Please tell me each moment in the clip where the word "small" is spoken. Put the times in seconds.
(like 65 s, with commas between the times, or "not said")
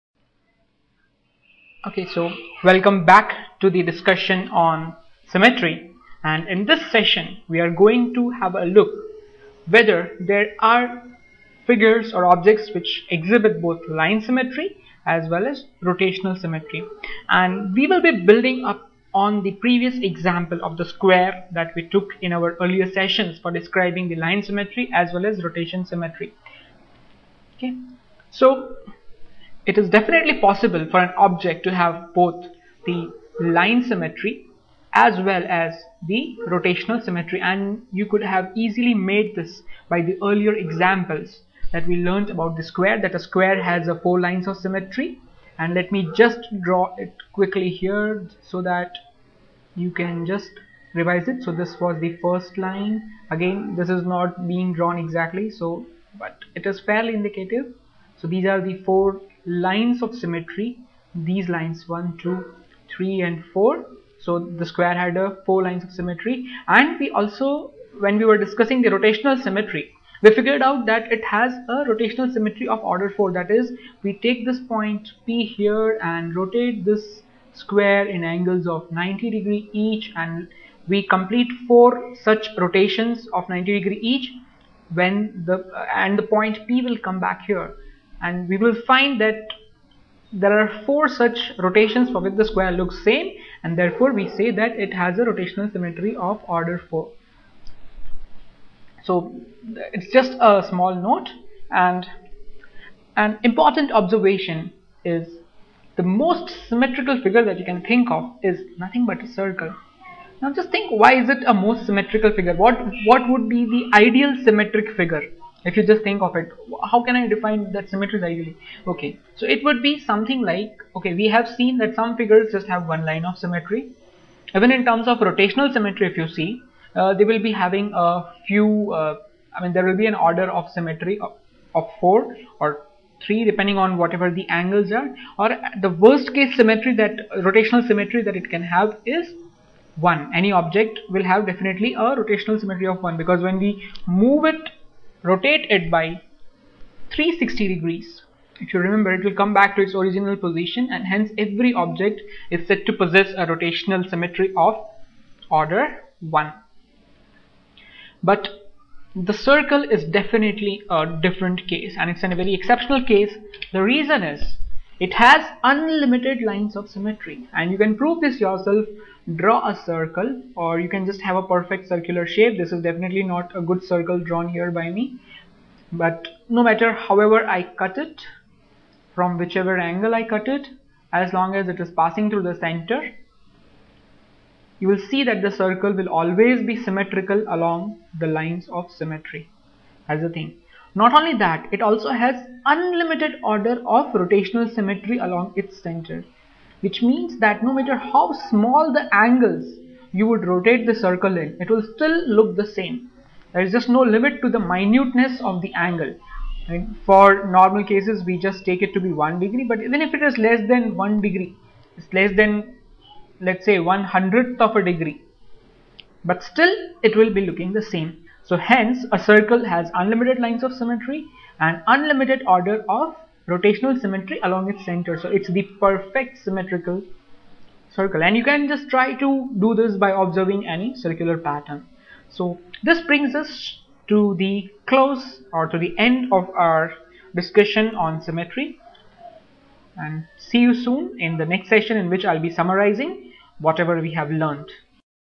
100 s, 198 s.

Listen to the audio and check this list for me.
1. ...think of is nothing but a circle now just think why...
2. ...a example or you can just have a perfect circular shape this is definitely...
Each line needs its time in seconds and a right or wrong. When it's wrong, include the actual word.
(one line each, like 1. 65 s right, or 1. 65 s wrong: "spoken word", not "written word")
1. 107 s right
2. 169 s wrong: "circle", not "example".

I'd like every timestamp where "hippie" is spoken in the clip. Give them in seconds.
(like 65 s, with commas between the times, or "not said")
not said.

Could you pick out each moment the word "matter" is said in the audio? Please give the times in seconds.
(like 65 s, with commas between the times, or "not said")
176 s, 197 s.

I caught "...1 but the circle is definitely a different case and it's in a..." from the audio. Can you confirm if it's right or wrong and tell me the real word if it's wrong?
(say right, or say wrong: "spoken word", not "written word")
right.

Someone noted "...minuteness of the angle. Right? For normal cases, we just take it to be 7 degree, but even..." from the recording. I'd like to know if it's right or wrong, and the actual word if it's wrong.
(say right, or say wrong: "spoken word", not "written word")
wrong: "1", not "7".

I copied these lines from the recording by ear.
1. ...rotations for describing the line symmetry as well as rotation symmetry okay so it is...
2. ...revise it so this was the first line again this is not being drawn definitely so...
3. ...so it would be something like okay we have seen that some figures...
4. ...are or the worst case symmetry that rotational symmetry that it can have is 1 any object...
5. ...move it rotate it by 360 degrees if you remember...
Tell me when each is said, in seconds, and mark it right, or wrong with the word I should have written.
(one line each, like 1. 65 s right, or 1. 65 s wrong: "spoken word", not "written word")
1. 22 s wrong: "sessions", not "rotations"
2. 50 s wrong: "exactly", not "definitely"
3. 119 s right
4. 134 s right
5. 144 s right.